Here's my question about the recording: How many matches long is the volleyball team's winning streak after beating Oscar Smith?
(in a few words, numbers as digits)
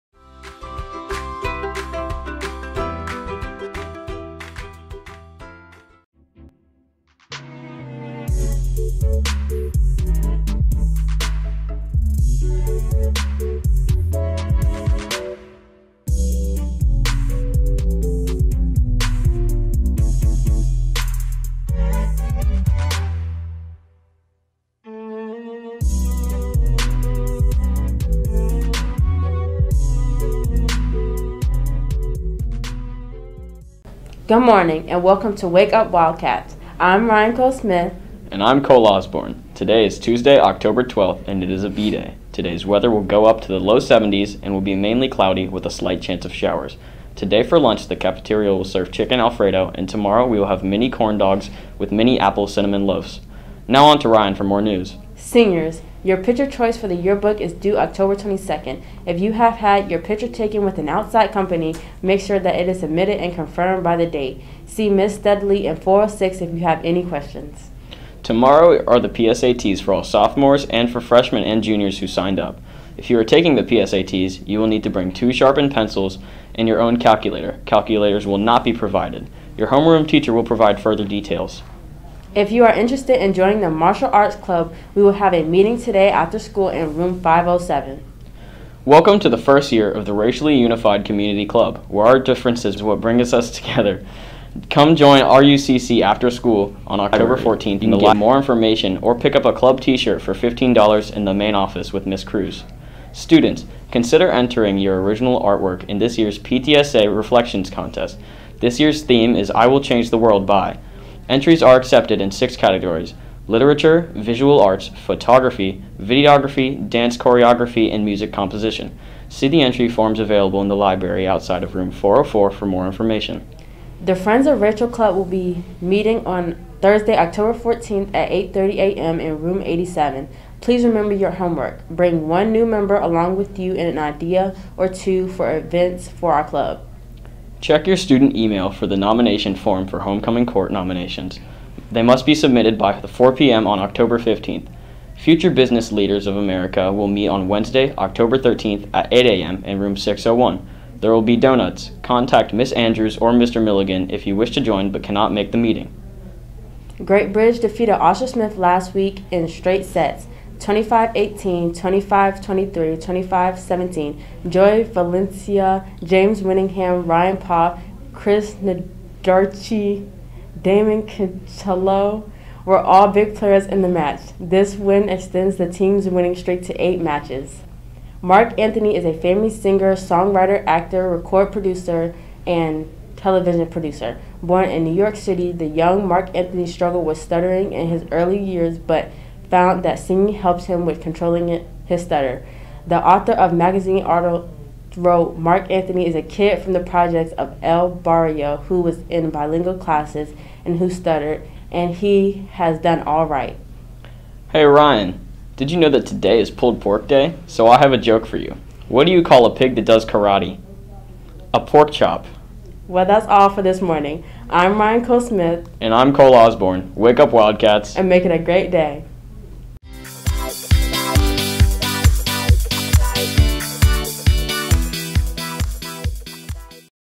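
8.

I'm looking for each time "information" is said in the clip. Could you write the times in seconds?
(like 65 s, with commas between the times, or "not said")
98 s, 122 s.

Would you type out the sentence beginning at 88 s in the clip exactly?
Welcome to the first year of the Racially Unified Community Club, where our differences will bring us together.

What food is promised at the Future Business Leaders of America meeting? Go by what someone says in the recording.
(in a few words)
Donuts.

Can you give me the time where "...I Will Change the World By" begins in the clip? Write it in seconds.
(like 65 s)
109 s.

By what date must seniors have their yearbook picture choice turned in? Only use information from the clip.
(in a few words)
October 22nd.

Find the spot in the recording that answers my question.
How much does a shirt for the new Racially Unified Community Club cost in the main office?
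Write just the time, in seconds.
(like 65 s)
100 s.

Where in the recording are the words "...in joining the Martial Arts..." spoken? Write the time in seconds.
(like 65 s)
83 s.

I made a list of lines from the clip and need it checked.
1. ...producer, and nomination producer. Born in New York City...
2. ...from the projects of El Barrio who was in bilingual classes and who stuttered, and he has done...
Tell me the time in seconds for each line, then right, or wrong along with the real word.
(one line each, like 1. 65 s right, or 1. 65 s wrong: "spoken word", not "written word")
1. 181 s wrong: "television", not "nomination"
2. 196 s right.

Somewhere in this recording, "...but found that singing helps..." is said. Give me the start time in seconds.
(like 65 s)
188 s.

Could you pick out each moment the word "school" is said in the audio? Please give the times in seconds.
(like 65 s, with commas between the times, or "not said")
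86 s, 96 s.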